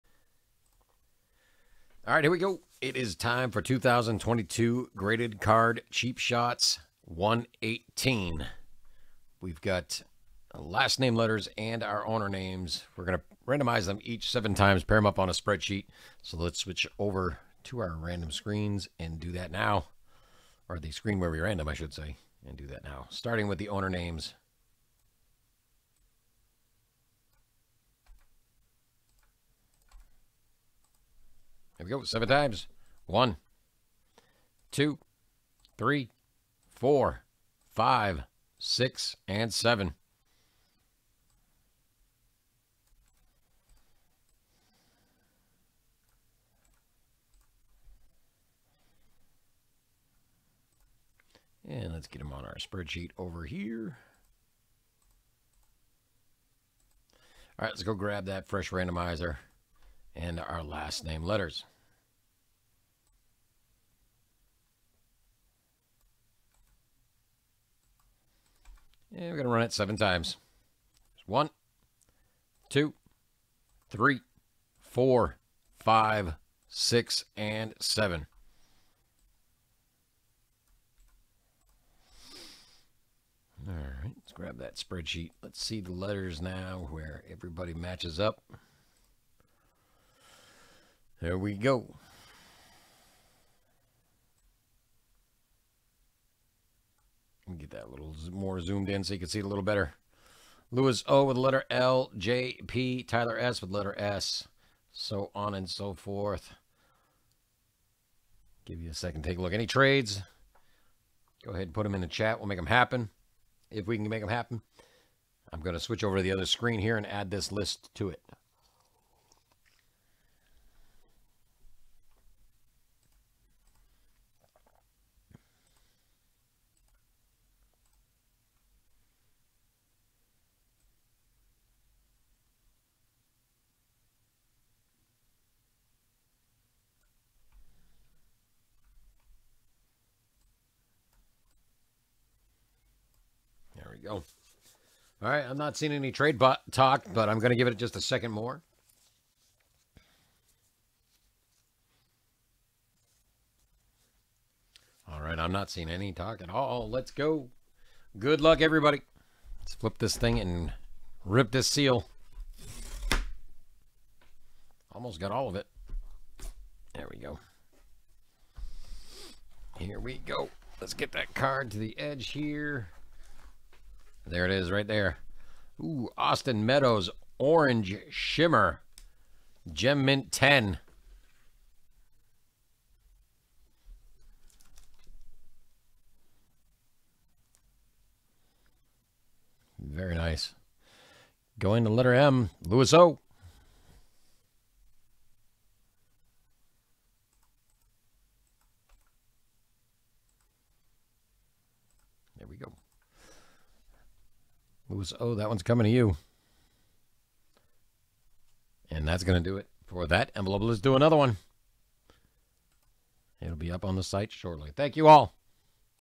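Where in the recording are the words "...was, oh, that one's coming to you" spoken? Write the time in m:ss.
3:24.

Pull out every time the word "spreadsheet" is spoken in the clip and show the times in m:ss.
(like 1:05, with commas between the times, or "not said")
0:15, 0:52, 1:24.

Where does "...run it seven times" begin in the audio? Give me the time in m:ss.
1:09.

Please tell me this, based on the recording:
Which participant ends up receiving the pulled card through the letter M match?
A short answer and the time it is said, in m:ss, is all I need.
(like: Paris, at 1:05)
Louis O, at 3:12.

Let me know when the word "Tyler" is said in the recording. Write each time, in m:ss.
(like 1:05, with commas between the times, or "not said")
1:43.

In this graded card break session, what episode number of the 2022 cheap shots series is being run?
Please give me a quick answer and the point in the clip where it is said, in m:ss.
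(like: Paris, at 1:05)
118, at 0:07.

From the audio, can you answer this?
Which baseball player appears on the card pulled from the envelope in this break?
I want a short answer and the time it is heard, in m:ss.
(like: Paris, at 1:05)
Austin Meadows, at 2:56.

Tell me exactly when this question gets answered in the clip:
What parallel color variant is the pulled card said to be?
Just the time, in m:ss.
2:57.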